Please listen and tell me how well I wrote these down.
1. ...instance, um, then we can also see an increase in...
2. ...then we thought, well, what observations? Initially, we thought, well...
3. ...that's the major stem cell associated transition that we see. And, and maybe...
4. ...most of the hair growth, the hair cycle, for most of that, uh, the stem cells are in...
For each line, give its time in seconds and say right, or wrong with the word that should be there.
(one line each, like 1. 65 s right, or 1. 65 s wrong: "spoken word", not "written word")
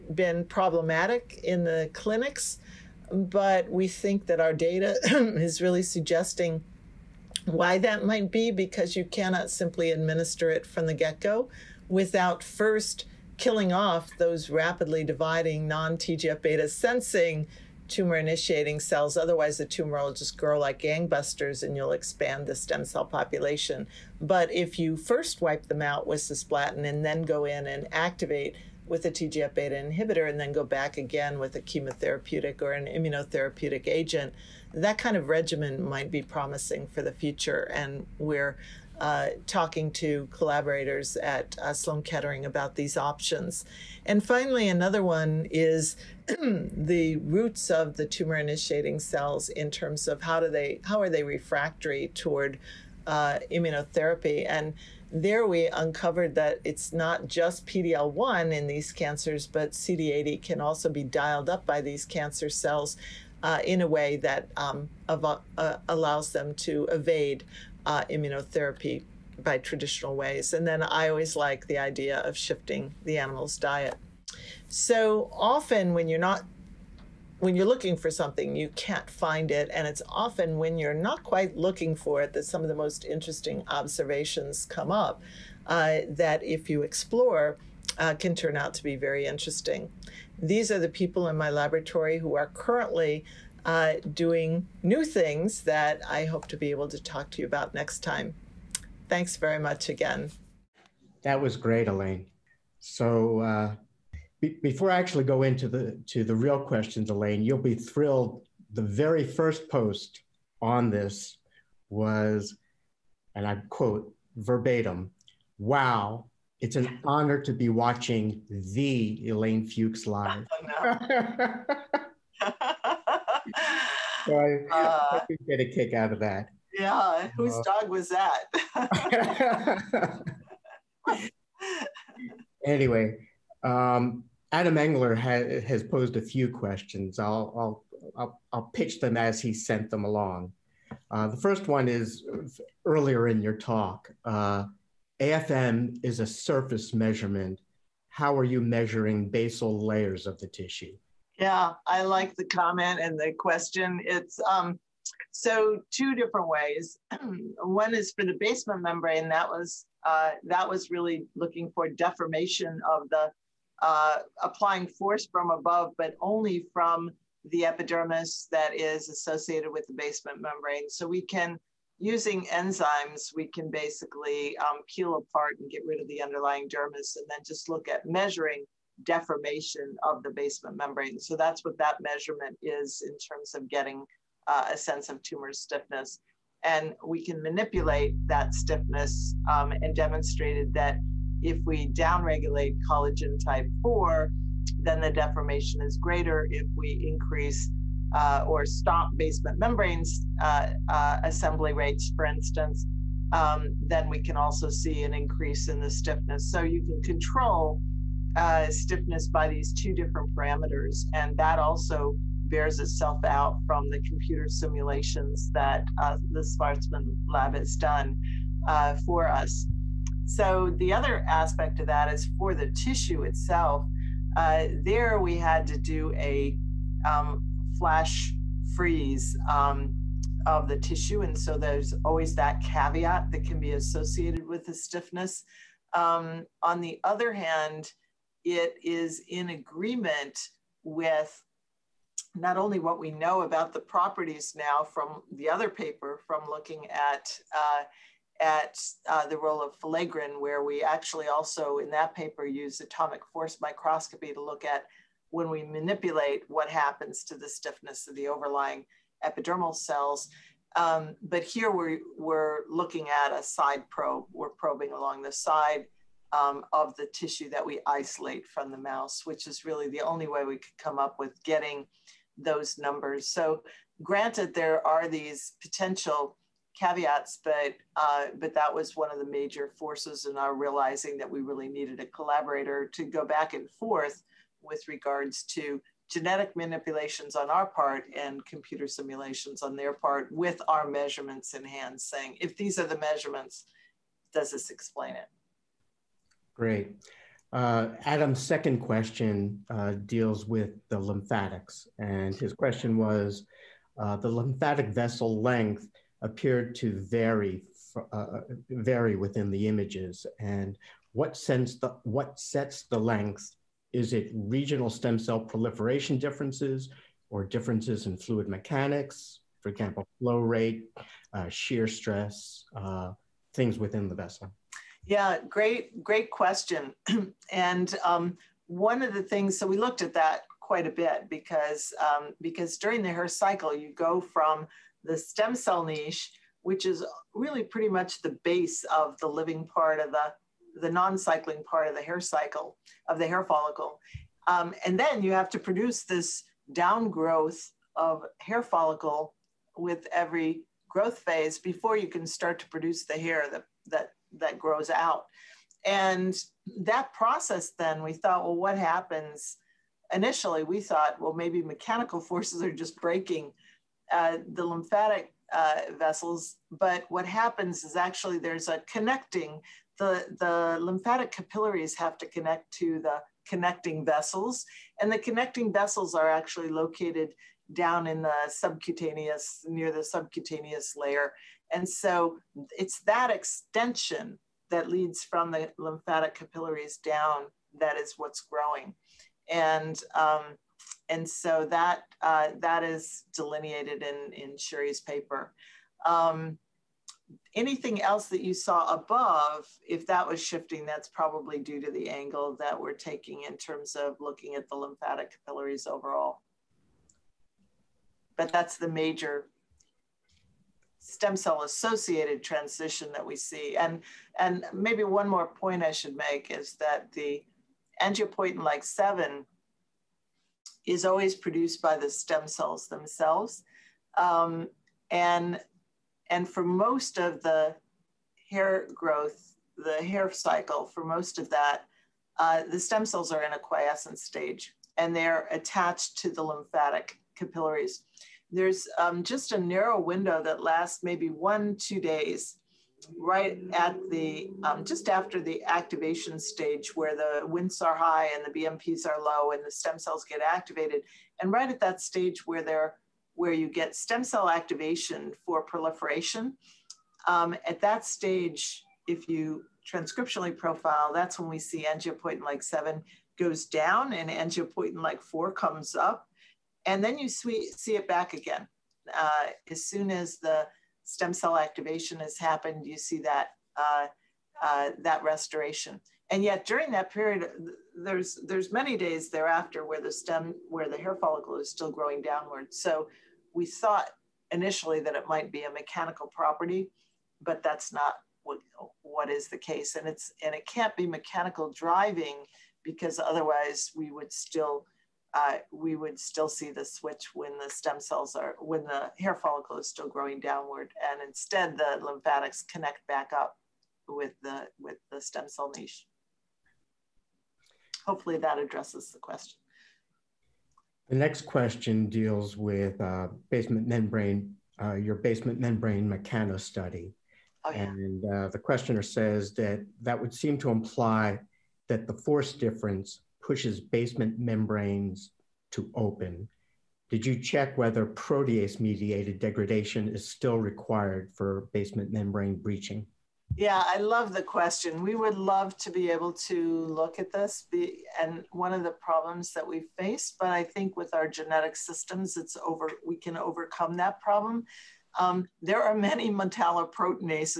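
1. 202 s right
2. 357 s wrong: "happens", not "observations"
3. 408 s right
4. 426 s right.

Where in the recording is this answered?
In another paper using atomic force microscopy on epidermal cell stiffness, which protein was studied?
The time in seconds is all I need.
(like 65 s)
249 s.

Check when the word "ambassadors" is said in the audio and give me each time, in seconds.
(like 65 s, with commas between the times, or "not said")
not said.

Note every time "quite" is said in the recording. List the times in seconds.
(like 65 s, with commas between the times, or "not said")
81 s, 330 s.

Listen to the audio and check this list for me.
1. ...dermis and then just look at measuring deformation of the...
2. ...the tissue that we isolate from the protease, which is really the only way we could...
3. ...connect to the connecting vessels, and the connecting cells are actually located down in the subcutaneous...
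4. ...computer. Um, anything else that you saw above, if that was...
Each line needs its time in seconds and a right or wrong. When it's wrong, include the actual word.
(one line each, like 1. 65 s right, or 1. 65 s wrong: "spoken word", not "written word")
1. 176 s right
2. 266 s wrong: "mouse", not "protease"
3. 372 s wrong: "vessels", not "cells"
4. 395 s wrong: "paper", not "computer".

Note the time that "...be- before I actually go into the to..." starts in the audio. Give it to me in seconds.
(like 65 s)
104 s.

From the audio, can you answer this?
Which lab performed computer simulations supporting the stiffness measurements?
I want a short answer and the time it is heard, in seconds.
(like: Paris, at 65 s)
the Schwarzman lab, at 216 s.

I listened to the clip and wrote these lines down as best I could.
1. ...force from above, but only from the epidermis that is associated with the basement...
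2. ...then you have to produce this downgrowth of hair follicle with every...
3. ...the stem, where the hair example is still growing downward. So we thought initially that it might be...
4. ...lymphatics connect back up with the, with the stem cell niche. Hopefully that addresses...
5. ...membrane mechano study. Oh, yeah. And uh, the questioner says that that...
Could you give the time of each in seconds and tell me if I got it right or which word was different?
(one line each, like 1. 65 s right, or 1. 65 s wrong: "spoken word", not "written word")
1. 164 s right
2. 344 s right
3. 480 s wrong: "follicle", not "example"
4. 502 s right
5. 515 s right.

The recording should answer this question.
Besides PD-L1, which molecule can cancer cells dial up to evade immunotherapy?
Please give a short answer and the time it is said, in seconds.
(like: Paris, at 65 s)
CD80, at 59 s.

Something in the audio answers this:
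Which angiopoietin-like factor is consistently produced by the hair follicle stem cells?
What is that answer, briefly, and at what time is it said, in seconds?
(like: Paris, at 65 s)
angiopoietin-like 7, at 418 s.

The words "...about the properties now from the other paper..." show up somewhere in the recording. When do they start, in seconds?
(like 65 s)
243 s.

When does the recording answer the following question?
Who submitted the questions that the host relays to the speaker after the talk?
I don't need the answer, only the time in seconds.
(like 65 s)
134 s.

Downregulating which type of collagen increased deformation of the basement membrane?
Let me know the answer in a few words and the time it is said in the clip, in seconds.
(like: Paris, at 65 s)
collagen type 4, at 192 s.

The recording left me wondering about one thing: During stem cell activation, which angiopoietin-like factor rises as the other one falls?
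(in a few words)
angiopoietin-like 4.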